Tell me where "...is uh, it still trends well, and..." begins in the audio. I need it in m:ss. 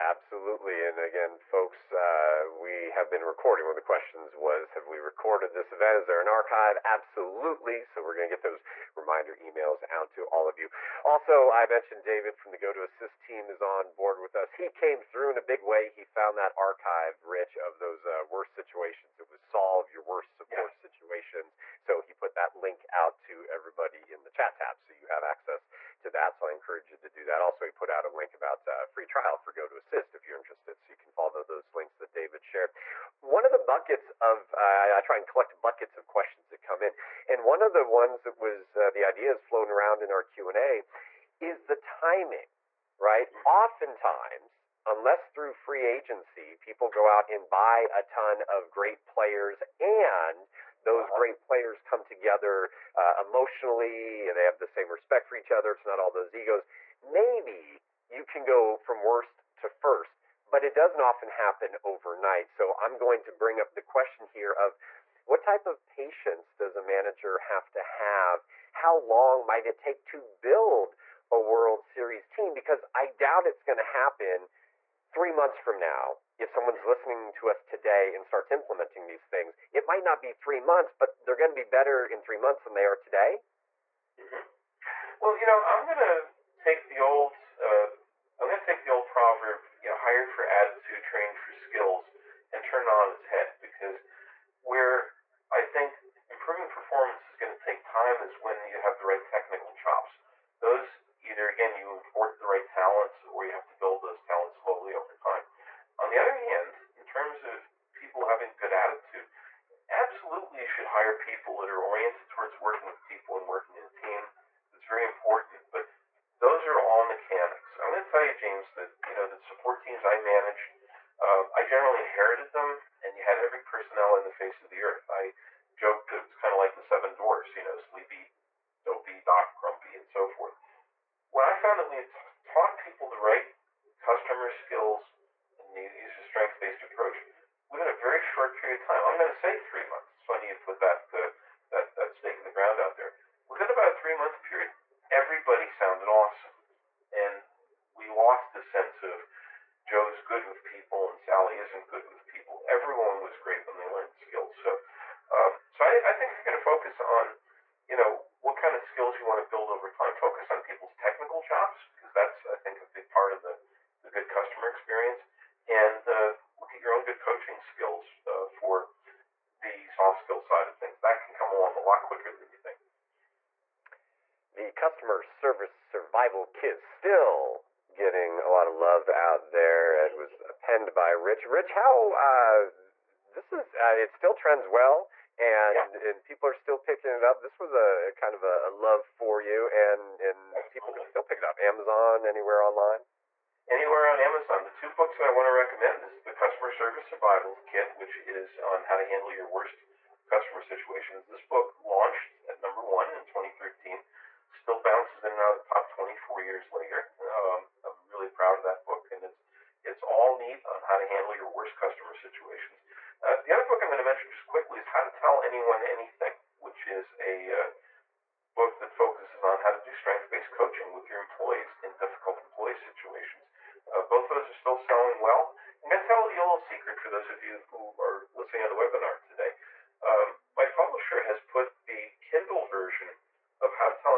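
3:03.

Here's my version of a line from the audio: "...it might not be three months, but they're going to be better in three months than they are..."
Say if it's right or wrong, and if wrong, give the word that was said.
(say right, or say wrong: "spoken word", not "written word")
right.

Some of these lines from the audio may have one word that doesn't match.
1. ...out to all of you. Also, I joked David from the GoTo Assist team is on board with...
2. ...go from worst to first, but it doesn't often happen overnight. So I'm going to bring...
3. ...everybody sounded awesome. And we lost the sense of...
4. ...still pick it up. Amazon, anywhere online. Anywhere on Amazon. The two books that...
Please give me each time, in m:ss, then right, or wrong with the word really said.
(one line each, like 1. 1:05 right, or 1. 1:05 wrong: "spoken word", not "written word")
1. 0:09 wrong: "mentioned", not "joked"
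2. 0:58 right
3. 2:25 right
4. 3:11 right.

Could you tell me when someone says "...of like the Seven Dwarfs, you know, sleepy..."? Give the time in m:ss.
2:06.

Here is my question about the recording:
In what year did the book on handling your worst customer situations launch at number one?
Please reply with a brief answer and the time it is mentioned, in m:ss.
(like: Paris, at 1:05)
2013, at 3:23.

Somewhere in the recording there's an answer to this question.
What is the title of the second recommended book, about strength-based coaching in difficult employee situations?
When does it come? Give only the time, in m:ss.
3:34.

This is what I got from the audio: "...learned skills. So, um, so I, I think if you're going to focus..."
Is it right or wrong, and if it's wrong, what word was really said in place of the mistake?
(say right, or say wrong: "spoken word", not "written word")
right.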